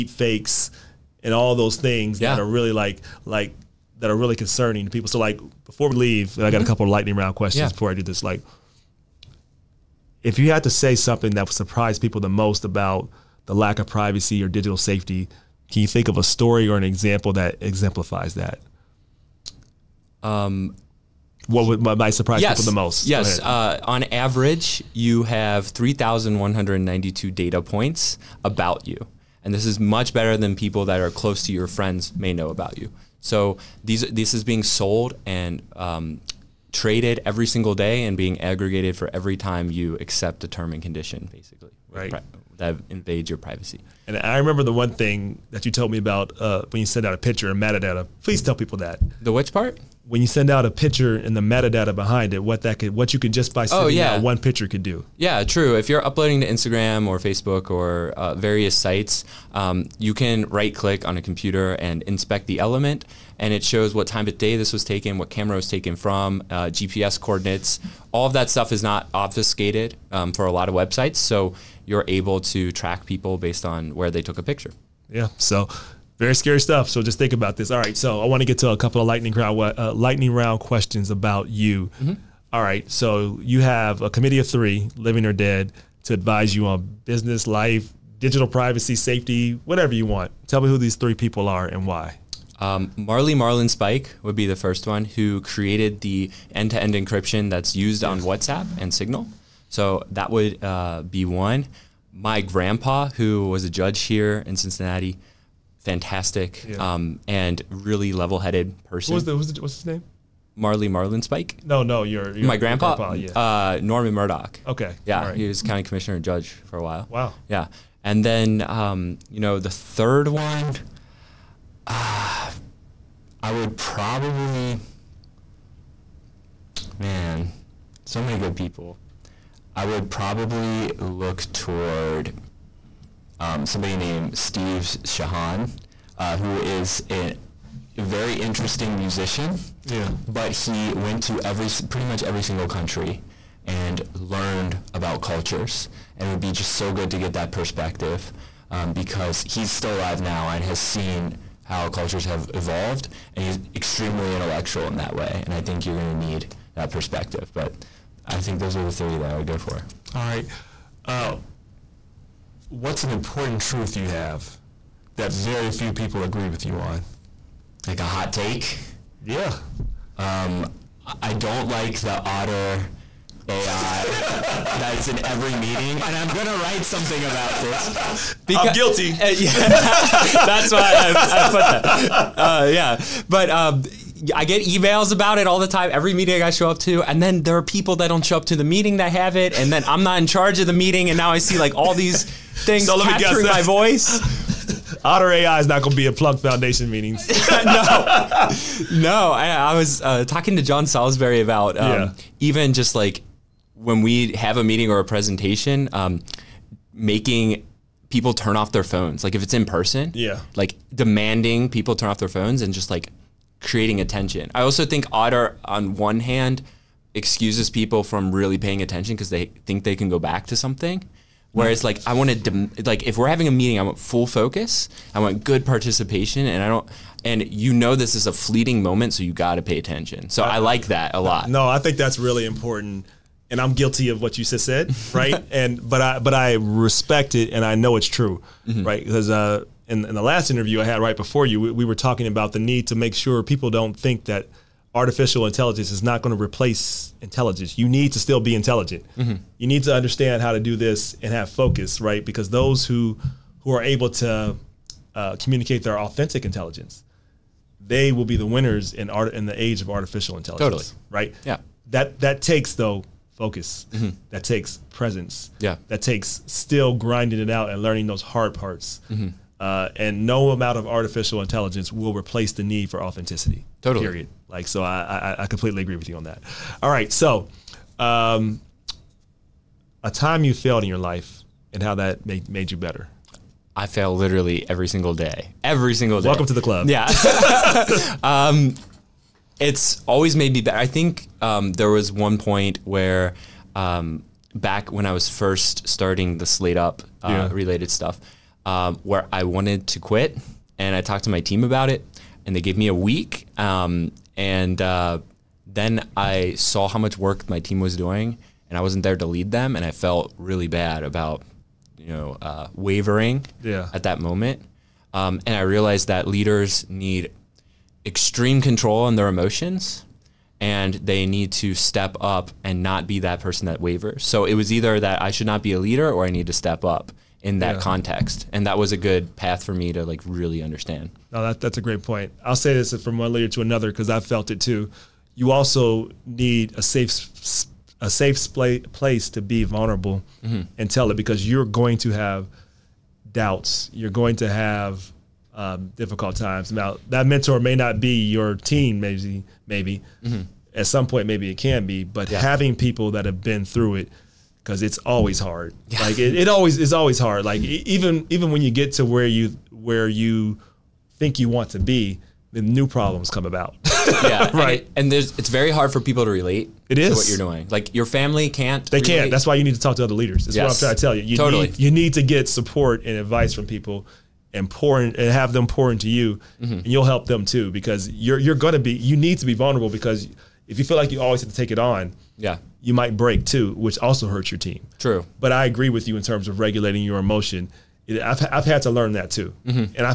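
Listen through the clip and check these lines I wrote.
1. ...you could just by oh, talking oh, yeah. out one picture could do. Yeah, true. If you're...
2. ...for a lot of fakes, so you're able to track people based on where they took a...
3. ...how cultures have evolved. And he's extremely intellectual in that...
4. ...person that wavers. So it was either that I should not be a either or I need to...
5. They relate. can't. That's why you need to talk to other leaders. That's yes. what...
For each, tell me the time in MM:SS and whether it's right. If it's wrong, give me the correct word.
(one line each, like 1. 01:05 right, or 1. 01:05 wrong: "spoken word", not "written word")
1. 00:53 wrong: "sending", not "talking"
2. 01:10 wrong: "websites", not "fakes"
3. 02:31 right
4. 05:23 wrong: "leader", not "either"
5. 06:08 right.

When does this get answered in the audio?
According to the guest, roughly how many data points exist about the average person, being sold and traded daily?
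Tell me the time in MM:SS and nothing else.
00:25.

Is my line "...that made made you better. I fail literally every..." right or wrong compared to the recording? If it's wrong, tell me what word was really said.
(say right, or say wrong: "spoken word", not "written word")
right.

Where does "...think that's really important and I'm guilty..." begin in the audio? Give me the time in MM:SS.
03:51.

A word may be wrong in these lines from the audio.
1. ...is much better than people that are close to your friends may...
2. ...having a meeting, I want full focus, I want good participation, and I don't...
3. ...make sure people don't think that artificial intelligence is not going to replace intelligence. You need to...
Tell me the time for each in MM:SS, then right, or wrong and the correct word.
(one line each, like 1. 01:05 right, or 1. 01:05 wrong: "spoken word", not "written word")
1. 00:29 right
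2. 03:43 right
3. 04:02 right.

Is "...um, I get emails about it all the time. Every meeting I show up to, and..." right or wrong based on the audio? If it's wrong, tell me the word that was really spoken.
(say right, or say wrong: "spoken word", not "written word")
right.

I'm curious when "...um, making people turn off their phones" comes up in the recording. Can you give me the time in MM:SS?
03:25.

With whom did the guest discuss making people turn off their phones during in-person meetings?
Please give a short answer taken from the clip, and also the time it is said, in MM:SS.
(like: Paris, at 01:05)
John Salisbury, at 03:20.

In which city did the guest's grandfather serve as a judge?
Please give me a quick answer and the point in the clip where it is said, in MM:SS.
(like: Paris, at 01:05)
Cincinnati, at 01:44.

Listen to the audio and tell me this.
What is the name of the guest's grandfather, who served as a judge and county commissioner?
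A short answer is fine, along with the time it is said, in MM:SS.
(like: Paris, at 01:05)
Norman Murdock, at 01:53.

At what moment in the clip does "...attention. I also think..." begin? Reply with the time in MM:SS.
03:34.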